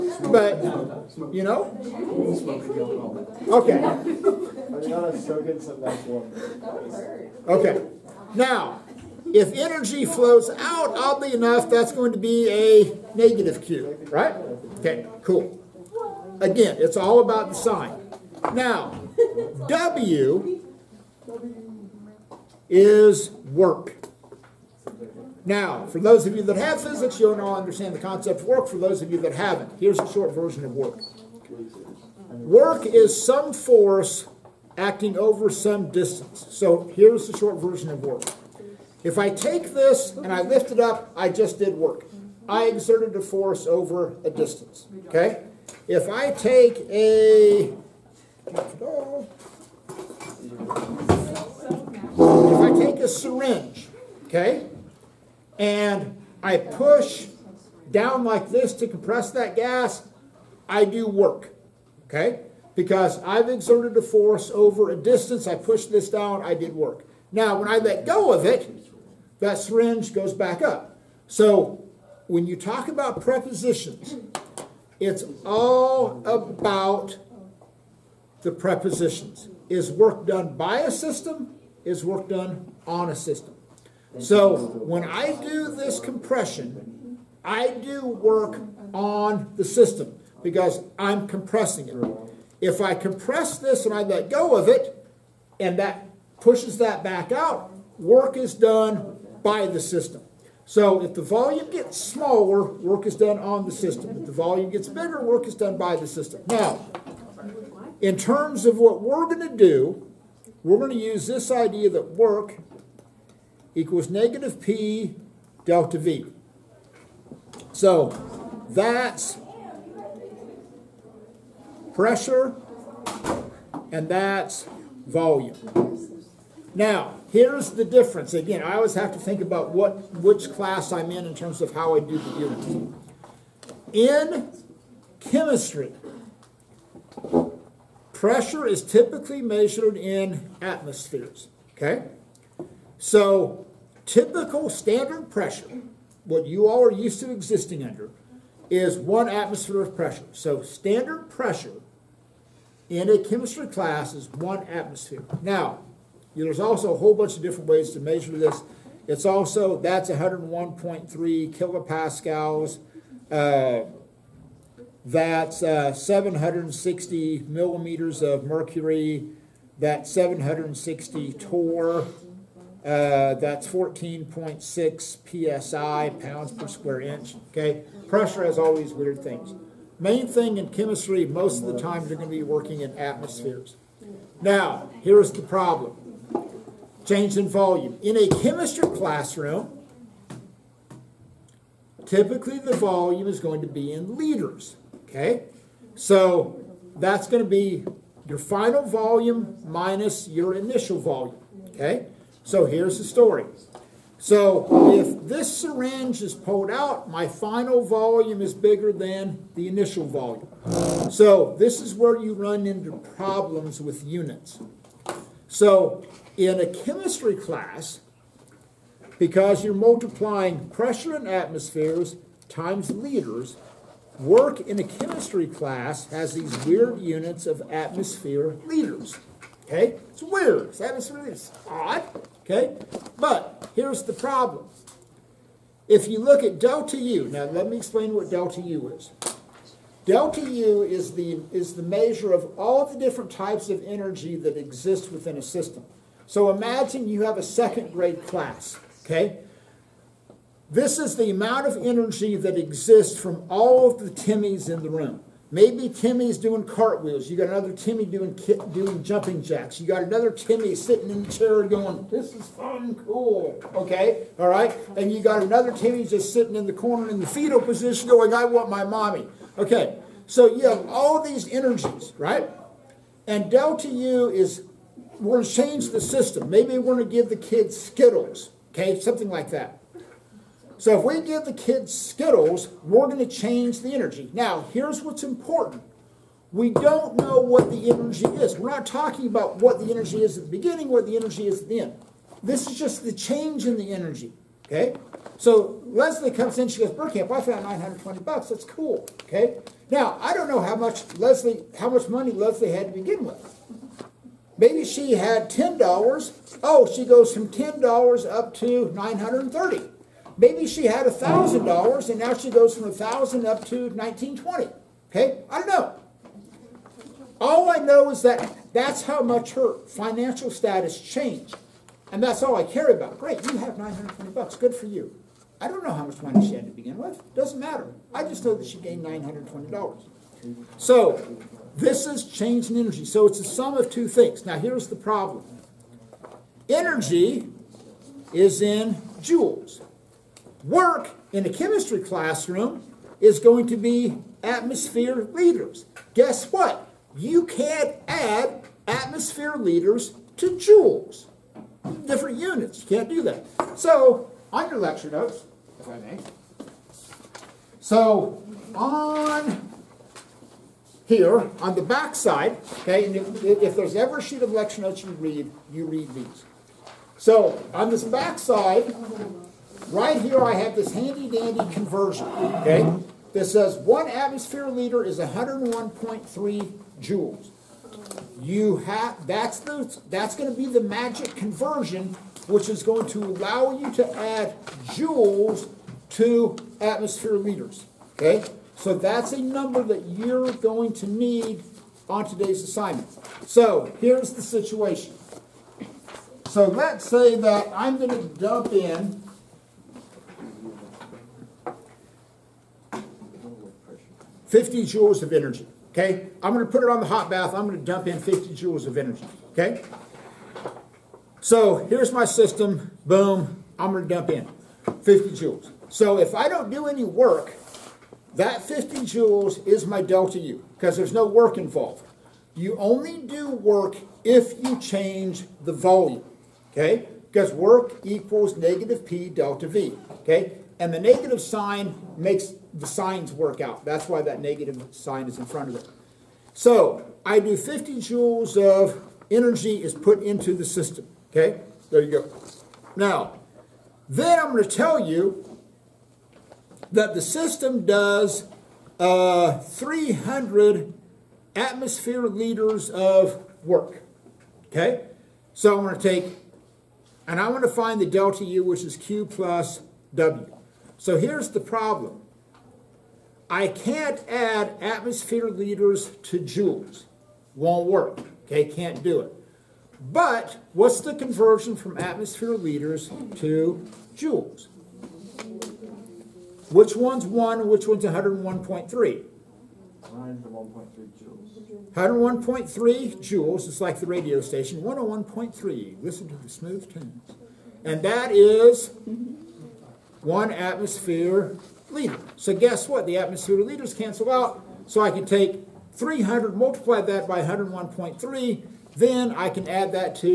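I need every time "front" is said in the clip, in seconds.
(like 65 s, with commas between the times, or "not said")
435 s.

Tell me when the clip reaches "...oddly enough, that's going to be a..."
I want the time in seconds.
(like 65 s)
10 s.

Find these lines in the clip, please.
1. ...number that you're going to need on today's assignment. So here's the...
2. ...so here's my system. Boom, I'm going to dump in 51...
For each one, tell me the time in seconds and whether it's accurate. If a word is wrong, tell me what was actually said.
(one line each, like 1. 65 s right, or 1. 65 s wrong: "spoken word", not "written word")
1. 389 s right
2. 411 s wrong: "50", not "51".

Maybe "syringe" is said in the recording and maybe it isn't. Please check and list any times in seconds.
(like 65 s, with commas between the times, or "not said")
53 s, 69 s, 205 s.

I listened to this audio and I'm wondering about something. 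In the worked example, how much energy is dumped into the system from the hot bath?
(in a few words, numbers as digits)
50 joules.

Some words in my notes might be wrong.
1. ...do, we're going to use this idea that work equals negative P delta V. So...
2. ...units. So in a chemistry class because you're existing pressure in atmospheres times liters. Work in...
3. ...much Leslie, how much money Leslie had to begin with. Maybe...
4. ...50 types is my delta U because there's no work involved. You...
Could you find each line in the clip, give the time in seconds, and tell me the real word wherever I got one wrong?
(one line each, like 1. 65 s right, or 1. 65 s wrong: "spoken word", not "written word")
1. 109 s right
2. 214 s wrong: "multiplying", not "existing"
3. 300 s right
4. 418 s wrong: "joules", not "types".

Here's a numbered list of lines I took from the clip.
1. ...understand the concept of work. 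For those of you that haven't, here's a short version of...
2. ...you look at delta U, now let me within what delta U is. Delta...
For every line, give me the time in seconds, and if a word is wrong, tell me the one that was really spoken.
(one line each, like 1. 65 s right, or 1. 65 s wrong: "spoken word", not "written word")
1. 27 s right
2. 236 s wrong: "explain", not "within".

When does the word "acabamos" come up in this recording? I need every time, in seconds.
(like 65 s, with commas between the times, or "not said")
not said.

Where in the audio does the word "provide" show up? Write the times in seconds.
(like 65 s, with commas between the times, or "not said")
not said.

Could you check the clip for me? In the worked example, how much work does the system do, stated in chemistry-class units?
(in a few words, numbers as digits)
300 atmosphere liters.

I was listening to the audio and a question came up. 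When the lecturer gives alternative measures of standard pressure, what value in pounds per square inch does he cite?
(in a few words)
14.6 psi.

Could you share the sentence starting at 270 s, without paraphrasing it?
So you have all these energies, right?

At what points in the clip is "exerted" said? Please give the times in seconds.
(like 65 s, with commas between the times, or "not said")
42 s, 63 s.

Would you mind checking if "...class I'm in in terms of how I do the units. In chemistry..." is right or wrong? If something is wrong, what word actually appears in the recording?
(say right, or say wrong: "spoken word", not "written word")
right.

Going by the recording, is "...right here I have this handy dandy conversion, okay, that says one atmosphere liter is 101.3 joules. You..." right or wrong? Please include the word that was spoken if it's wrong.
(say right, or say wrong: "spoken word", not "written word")
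right.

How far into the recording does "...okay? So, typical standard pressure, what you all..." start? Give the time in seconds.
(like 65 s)
141 s.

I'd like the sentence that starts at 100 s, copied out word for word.
So if the volume gets smaller, work is done on the system.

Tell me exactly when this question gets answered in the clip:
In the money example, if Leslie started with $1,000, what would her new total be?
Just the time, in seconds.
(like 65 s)
313 s.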